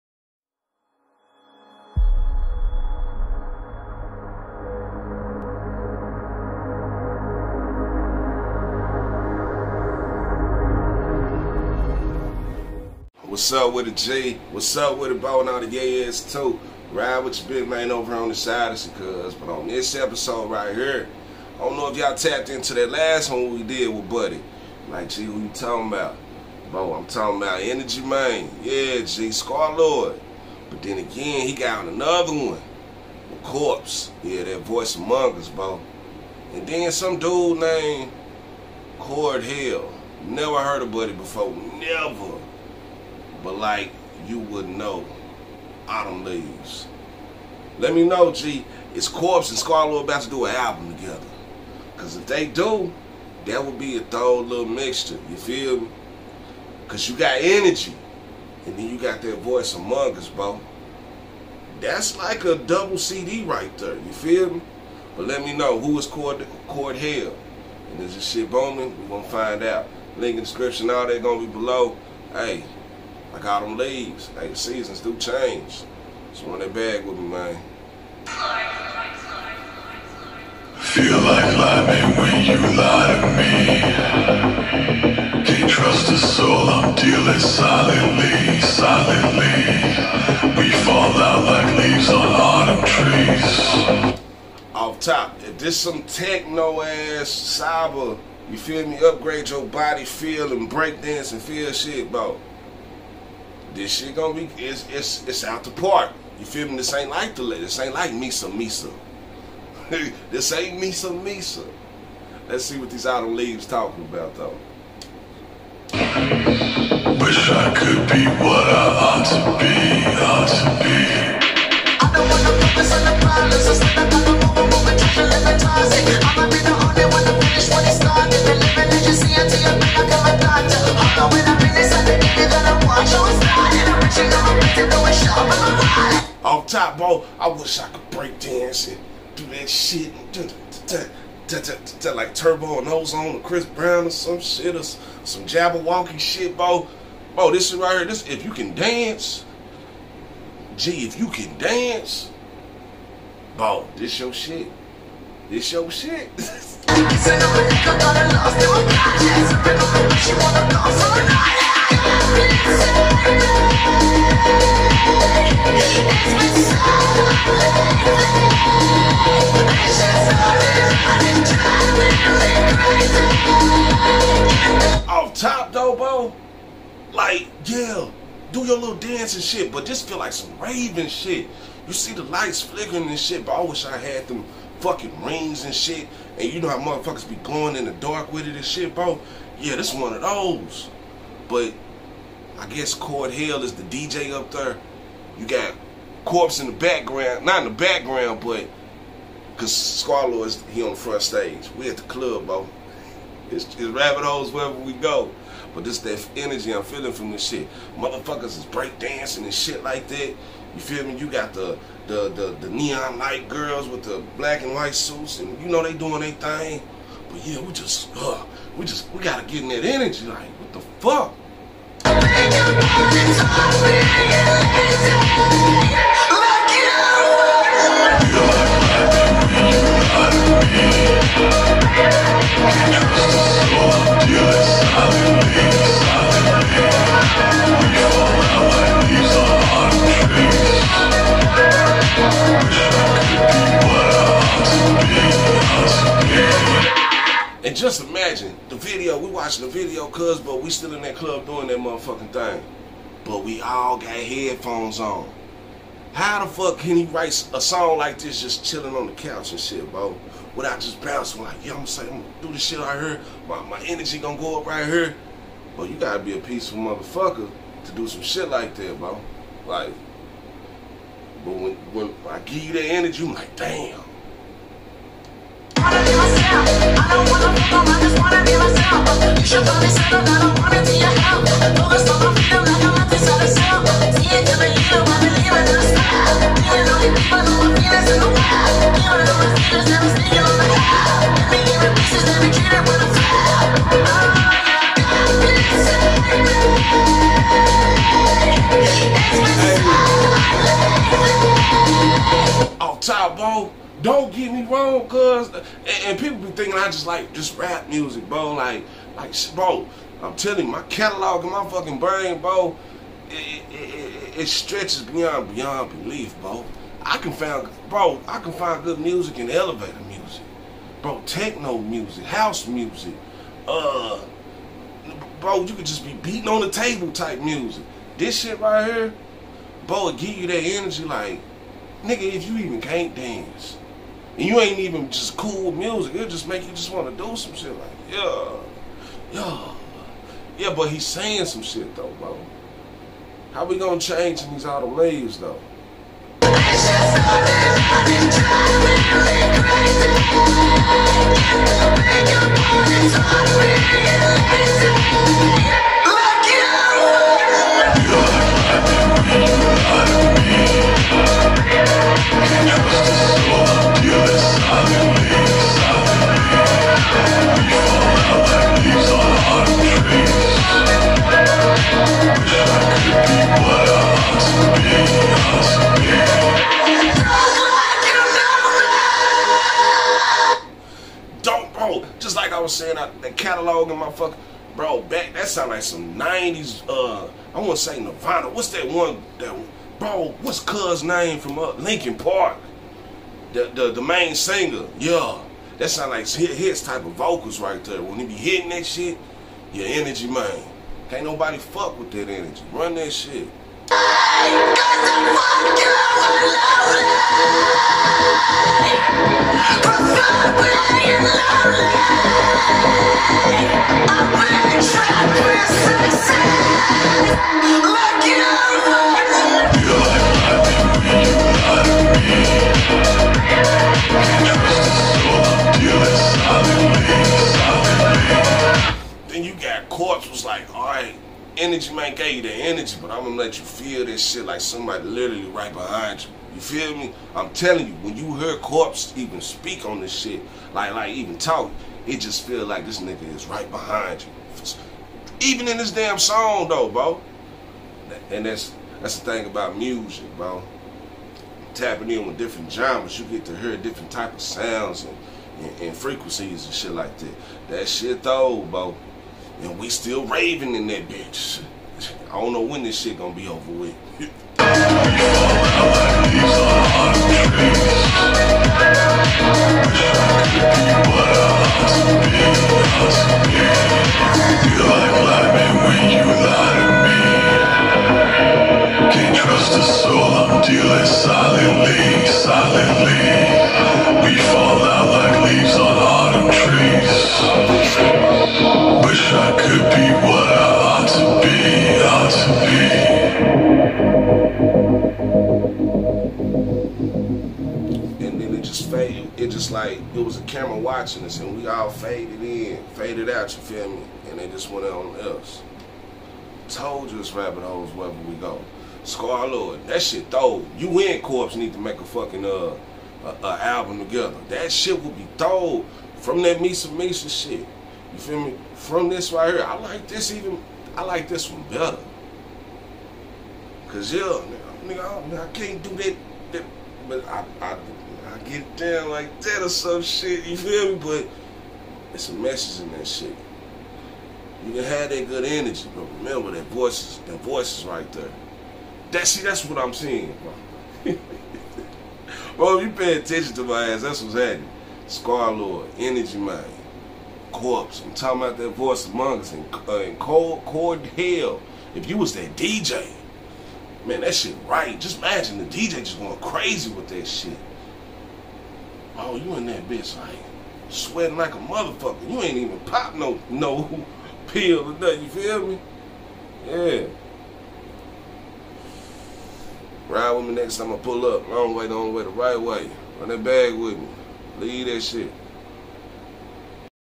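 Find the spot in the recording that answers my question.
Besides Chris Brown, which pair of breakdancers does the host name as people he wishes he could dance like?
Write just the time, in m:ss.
2:22.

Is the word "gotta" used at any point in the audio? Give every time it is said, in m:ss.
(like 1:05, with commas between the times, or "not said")
3:39, 4:25.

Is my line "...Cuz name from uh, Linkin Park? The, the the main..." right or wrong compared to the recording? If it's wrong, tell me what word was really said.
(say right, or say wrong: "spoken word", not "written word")
right.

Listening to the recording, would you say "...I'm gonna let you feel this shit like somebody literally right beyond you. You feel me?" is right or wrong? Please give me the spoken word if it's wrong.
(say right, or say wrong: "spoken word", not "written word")
wrong: "behind", not "beyond".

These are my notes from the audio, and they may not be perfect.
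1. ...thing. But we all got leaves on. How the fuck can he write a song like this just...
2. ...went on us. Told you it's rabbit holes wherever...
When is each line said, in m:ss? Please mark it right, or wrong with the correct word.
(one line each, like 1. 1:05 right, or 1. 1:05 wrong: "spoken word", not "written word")
1. 4:12 wrong: "headphones", not "leaves"
2. 8:24 right.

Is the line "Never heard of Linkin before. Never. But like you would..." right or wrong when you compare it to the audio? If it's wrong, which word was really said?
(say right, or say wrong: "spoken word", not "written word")
wrong: "Buddy", not "Linkin".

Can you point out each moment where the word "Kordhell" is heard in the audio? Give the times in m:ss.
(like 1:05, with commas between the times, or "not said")
0:38, 1:06, 3:12.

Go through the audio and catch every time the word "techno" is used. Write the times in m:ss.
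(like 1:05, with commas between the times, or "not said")
1:36, 5:21.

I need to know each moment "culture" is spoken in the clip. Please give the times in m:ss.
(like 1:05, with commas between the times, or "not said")
not said.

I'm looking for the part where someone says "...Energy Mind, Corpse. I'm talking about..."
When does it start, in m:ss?
9:05.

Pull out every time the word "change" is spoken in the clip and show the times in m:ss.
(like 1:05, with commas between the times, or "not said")
1:15, 5:43.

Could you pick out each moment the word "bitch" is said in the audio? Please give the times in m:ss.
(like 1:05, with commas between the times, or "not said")
7:41, 9:19.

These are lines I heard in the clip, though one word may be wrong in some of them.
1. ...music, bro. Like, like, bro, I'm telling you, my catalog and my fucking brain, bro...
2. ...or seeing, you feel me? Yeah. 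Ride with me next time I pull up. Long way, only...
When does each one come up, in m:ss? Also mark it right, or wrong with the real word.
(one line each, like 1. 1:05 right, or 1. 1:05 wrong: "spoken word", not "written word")
1. 5:07 right
2. 9:24 wrong: "nothing", not "seeing".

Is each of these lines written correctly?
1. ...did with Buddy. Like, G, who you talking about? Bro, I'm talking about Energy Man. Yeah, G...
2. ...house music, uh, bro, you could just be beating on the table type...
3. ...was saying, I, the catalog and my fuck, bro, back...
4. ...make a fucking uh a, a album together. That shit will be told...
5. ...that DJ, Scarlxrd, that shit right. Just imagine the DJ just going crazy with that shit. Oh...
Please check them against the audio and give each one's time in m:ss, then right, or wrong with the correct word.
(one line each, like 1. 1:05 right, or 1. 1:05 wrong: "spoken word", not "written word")
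1. 0:23 right
2. 5:22 right
3. 6:22 right
4. 8:31 right
5. 9:12 wrong: "Man", not "Scarlxrd".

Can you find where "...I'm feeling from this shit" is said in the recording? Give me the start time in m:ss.
3:26.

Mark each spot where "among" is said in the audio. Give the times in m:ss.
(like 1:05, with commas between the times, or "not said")
0:34, 0:59, 9:09.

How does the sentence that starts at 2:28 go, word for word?
This if you can dance, gee, if you can dance, bro, this your shit.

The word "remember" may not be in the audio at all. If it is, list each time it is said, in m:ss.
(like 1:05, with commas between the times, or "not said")
8:56.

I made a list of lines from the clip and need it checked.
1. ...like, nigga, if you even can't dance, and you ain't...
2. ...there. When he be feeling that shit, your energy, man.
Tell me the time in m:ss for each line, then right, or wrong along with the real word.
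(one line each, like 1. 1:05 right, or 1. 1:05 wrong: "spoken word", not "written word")
1. 5:31 right
2. 6:37 wrong: "hitting", not "feeling".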